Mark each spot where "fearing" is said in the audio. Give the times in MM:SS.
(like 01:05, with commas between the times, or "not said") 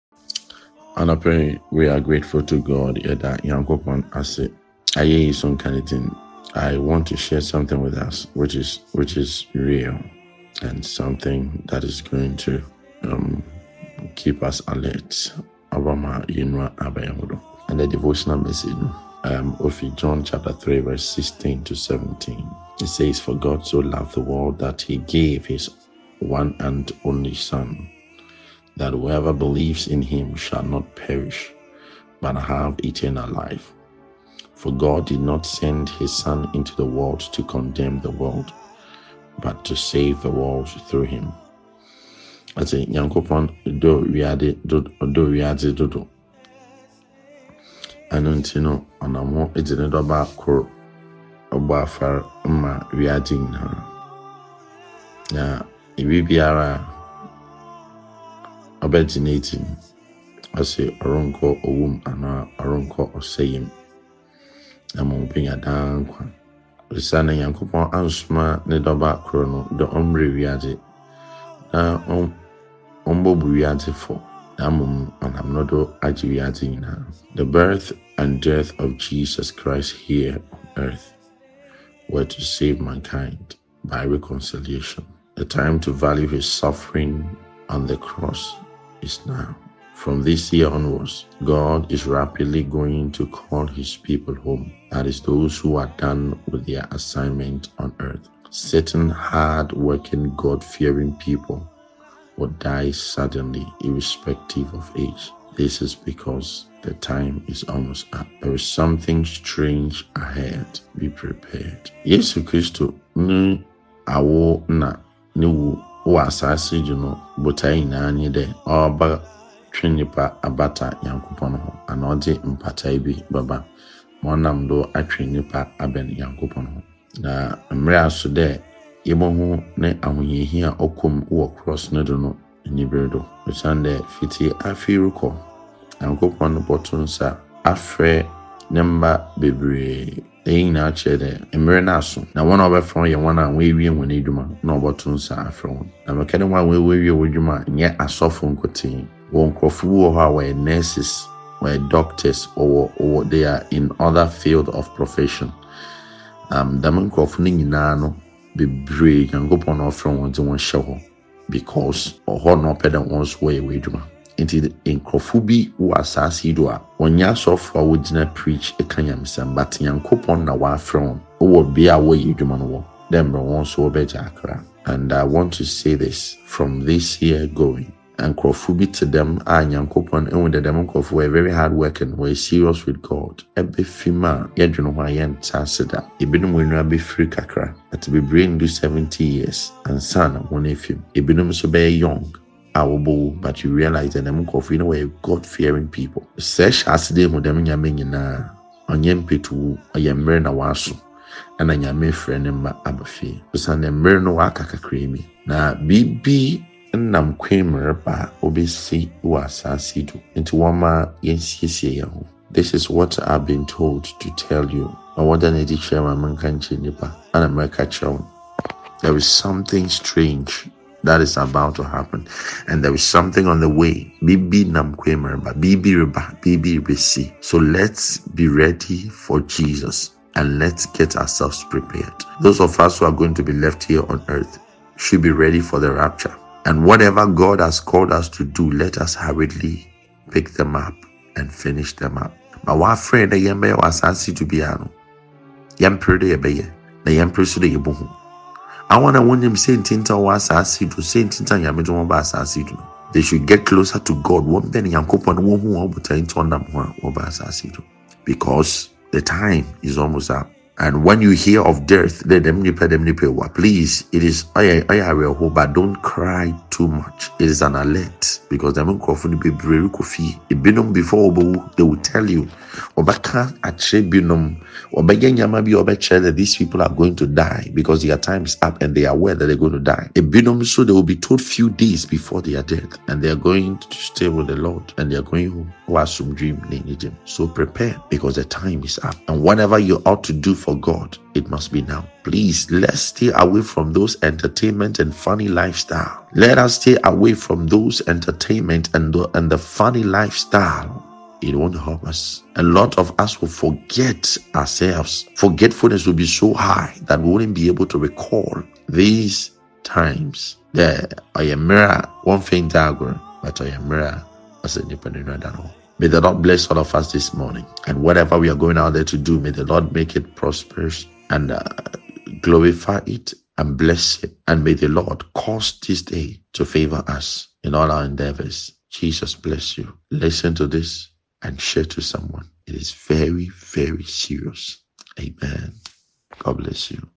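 01:40, 03:15.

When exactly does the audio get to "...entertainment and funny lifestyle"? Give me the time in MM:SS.
04:54.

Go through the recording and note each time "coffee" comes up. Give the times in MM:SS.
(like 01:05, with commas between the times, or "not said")
03:14.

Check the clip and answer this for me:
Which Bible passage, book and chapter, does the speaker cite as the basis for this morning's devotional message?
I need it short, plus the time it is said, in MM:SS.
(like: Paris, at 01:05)
John 3, at 00:19.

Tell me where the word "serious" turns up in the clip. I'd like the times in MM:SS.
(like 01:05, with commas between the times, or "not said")
03:02, 05:34.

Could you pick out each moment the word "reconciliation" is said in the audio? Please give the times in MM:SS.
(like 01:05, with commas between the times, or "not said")
01:24.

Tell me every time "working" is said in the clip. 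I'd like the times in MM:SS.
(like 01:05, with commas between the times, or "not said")
01:39, 03:01.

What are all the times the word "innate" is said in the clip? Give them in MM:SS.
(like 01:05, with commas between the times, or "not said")
not said.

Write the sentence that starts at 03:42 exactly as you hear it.
And there is something on the way.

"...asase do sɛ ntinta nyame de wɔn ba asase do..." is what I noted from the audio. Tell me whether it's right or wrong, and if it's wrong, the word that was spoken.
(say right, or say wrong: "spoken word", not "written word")
right.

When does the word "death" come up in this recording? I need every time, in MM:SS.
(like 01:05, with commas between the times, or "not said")
01:18, 04:21, 04:42.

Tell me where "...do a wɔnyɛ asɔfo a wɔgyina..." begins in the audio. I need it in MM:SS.
02:46.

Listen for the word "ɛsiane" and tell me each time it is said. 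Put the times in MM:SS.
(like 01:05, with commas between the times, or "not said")
01:06, 02:13.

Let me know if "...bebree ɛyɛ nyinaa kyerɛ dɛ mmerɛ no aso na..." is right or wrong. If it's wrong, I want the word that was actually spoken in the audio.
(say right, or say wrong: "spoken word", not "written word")
right.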